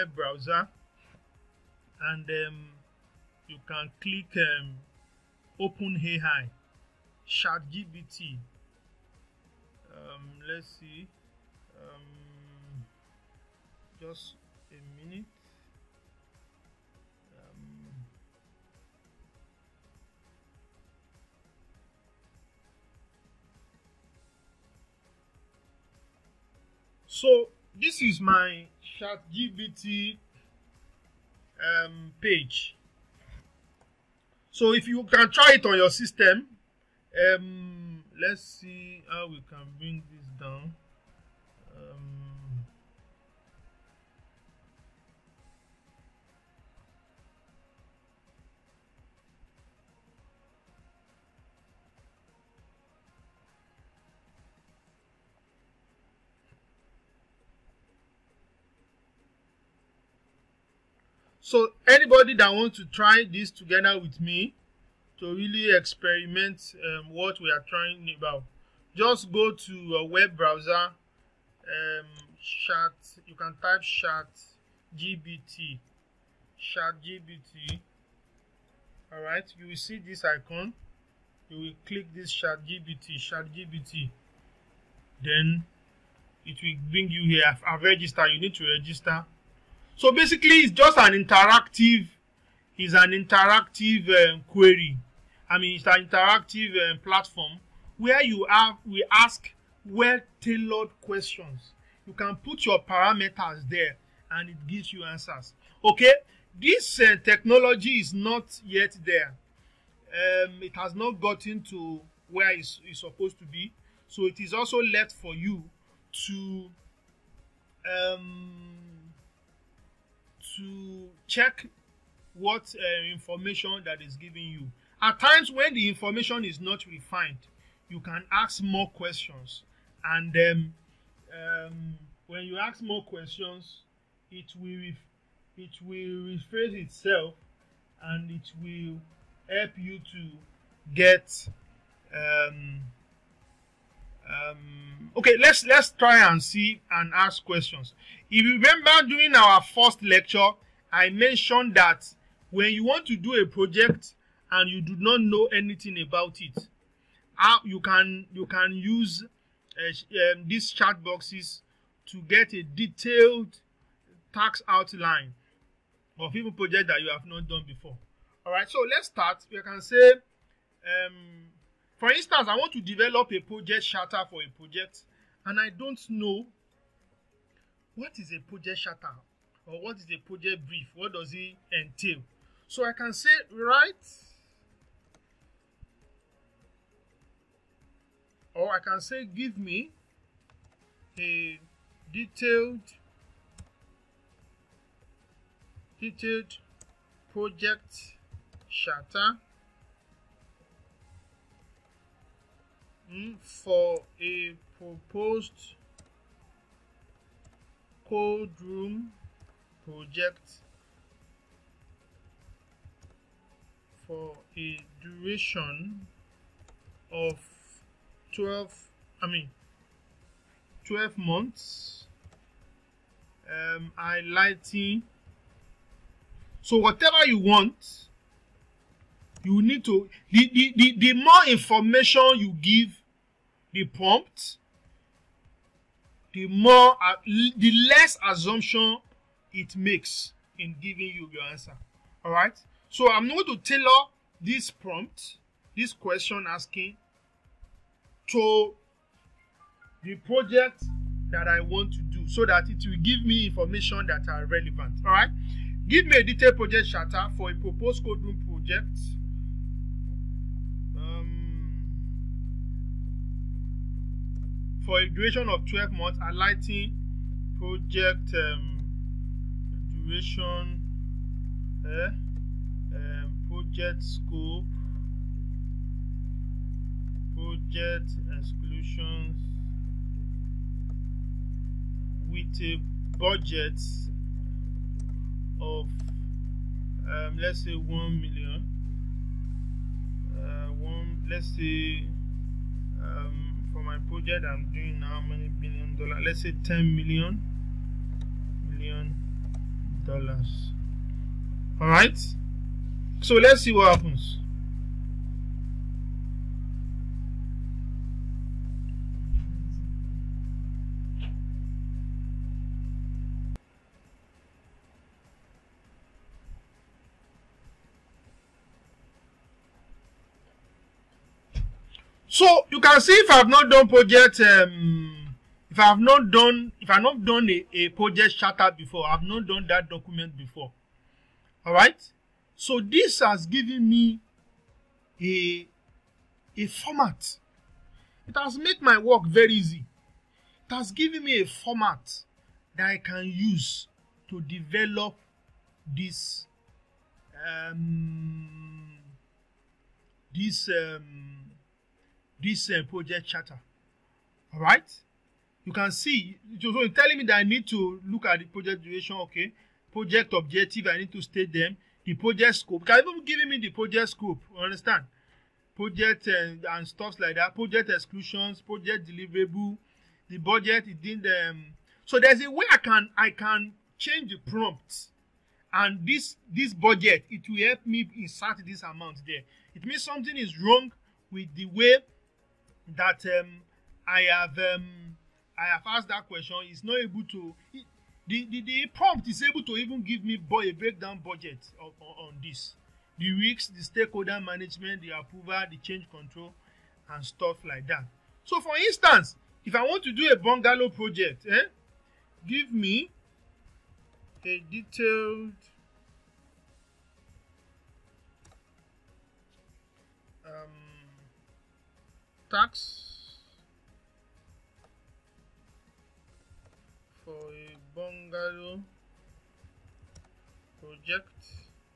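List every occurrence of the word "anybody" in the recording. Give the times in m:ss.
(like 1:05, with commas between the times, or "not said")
1:01.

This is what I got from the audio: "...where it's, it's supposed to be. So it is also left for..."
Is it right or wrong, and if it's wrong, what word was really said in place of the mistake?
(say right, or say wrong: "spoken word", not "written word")
right.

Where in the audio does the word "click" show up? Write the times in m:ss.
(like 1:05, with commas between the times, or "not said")
0:04, 1:21.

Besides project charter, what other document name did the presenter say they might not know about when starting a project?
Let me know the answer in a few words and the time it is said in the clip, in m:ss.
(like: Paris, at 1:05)
Project brief, at 3:00.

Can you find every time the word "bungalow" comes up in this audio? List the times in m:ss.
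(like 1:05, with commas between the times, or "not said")
6:40, 6:57.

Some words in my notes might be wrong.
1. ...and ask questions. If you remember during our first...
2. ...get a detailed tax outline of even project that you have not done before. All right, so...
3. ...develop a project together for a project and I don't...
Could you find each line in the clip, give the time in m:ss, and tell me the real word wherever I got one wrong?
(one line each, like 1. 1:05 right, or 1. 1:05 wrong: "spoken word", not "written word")
1. 2:26 right
2. 2:42 right
3. 2:52 wrong: "charter", not "together".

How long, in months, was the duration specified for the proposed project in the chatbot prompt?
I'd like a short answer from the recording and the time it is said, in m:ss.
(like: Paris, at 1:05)
12 months, at 3:40.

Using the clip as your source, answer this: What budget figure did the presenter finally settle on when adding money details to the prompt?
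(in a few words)
10 million dollars.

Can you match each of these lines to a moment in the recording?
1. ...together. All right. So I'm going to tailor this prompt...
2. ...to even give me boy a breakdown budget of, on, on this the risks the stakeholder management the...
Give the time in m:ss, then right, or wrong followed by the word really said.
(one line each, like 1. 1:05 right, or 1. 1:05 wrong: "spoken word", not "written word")
1. 4:01 wrong: "answer", not "together"
2. 6:29 right.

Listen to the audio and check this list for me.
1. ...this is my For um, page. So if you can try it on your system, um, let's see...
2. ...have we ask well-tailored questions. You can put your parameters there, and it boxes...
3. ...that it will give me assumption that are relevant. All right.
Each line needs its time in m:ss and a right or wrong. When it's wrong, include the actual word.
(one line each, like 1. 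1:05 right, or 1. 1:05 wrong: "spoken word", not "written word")
1. 0:27 wrong: "ChatGPT", not "For"
2. 1:38 wrong: "gives", not "boxes"
3. 4:12 wrong: "information", not "assumption".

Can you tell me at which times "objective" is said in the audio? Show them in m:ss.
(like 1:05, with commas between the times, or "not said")
6:00.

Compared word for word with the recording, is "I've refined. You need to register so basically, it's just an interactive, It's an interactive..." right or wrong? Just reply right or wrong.
wrong.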